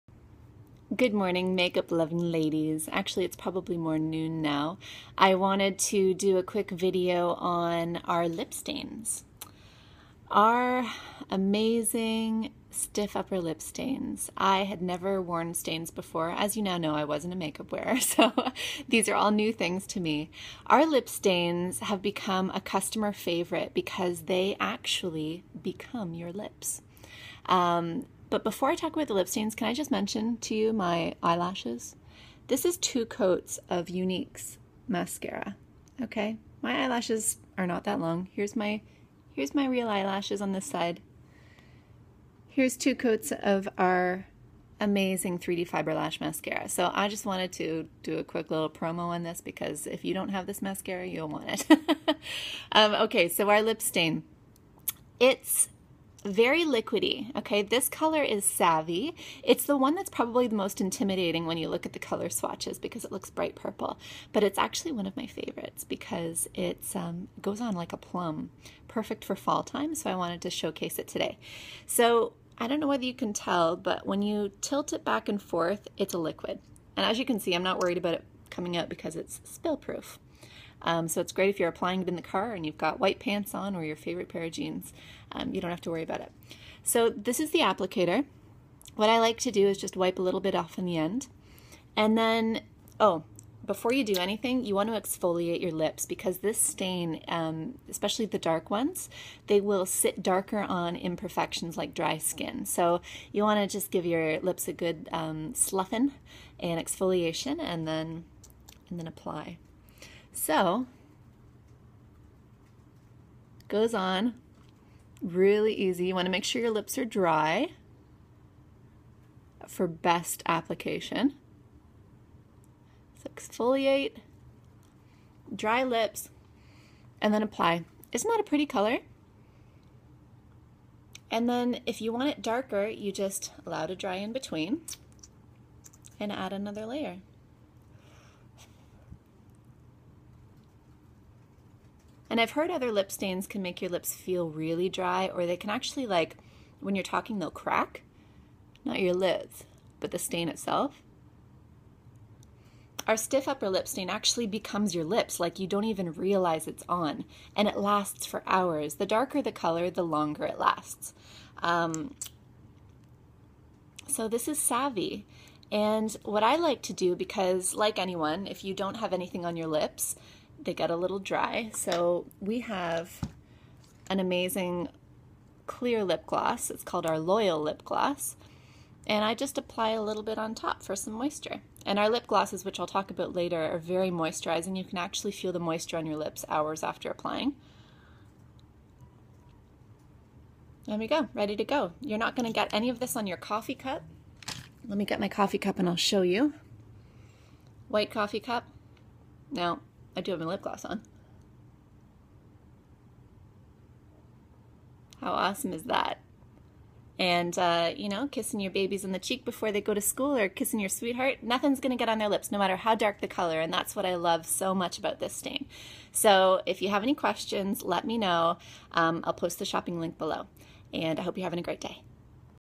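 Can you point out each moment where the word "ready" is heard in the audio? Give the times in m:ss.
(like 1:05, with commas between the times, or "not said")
3:11.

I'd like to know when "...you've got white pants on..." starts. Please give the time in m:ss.
1:22.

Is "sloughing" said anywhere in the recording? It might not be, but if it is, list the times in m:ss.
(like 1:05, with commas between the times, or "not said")
1:45.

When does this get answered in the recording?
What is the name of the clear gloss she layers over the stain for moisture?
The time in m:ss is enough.
2:57.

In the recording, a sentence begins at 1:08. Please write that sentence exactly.
Perfect for fall time, so I wanted to showcase it today.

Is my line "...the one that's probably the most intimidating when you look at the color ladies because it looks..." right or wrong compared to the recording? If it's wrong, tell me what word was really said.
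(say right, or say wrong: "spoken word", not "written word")
wrong: "swatches", not "ladies".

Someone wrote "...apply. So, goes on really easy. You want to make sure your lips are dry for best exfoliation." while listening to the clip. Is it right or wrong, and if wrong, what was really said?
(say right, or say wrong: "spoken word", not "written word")
wrong: "application", not "exfoliation".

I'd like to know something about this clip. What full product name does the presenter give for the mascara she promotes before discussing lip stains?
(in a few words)
3D Fiber Lash Mascara.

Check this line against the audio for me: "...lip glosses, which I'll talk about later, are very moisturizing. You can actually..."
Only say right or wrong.
right.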